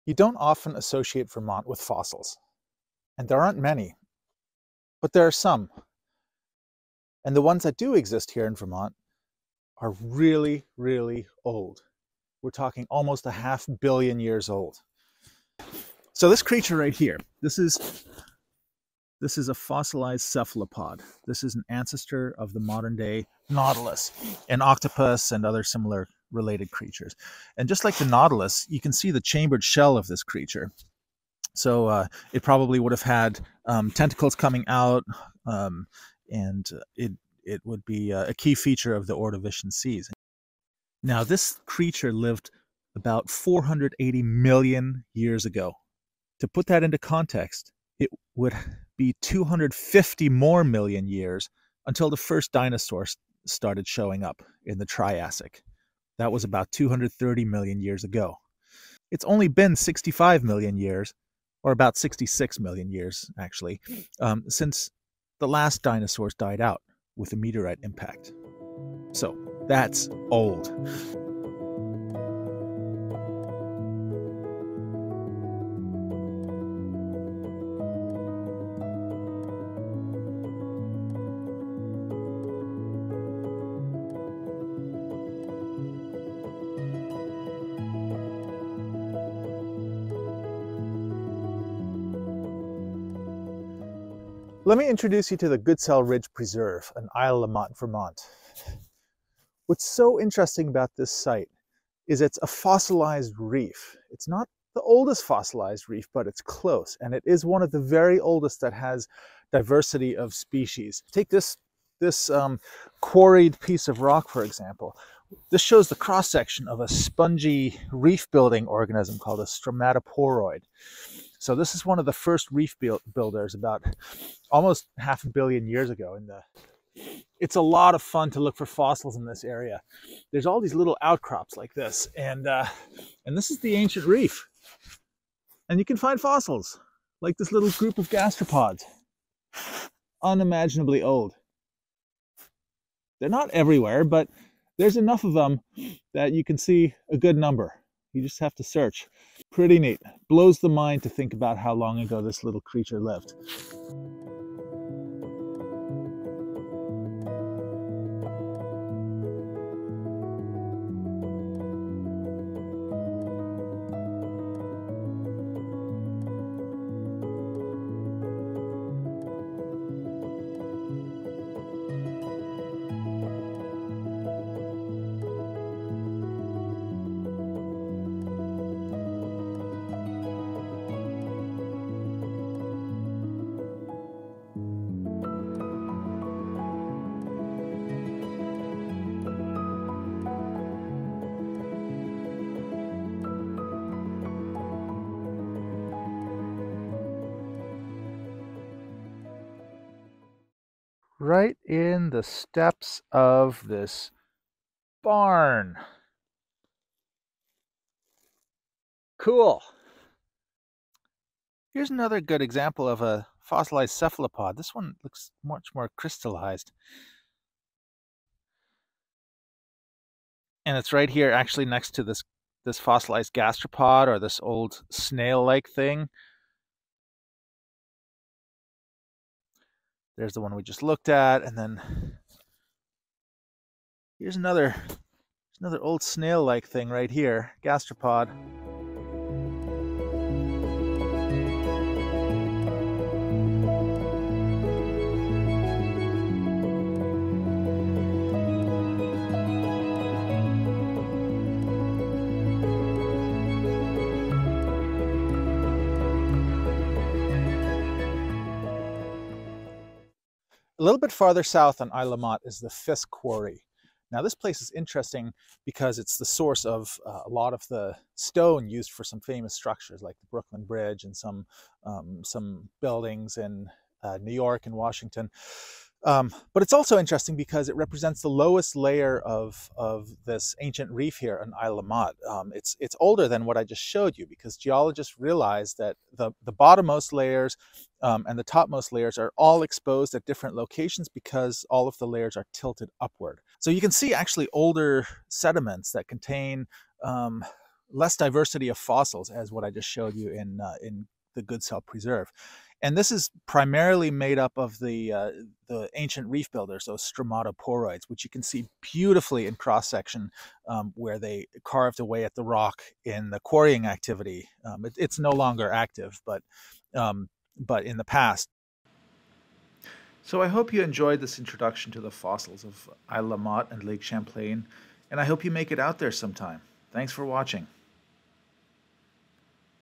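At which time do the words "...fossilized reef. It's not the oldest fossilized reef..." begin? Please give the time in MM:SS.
01:42.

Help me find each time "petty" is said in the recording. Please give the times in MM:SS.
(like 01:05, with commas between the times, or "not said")
not said.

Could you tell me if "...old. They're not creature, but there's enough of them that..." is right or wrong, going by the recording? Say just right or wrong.
wrong.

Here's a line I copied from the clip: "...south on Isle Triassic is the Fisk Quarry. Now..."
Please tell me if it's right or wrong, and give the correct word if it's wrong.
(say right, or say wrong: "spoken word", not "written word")
wrong: "Motte", not "Triassic".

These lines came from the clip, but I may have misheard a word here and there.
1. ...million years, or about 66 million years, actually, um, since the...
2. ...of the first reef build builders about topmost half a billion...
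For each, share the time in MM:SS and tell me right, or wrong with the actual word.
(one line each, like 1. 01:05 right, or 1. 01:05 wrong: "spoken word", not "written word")
1. 01:00 right
2. 02:01 wrong: "almost", not "topmost".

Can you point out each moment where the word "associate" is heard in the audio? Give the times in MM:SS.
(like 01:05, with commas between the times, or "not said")
00:00.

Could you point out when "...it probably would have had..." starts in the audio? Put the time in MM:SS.
00:32.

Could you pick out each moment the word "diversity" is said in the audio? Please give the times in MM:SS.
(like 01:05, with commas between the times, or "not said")
01:49, 04:58.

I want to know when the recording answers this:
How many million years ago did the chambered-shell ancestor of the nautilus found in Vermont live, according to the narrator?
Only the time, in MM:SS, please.
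00:43.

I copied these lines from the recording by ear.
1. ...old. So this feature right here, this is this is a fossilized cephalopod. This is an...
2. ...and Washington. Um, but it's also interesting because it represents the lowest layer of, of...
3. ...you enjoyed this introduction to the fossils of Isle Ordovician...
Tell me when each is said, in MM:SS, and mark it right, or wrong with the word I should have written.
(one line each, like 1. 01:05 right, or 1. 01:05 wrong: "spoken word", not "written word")
1. 00:14 wrong: "creature", not "feature"
2. 04:34 right
3. 05:20 wrong: "Motte", not "Ordovician".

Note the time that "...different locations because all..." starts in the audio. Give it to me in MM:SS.
04:50.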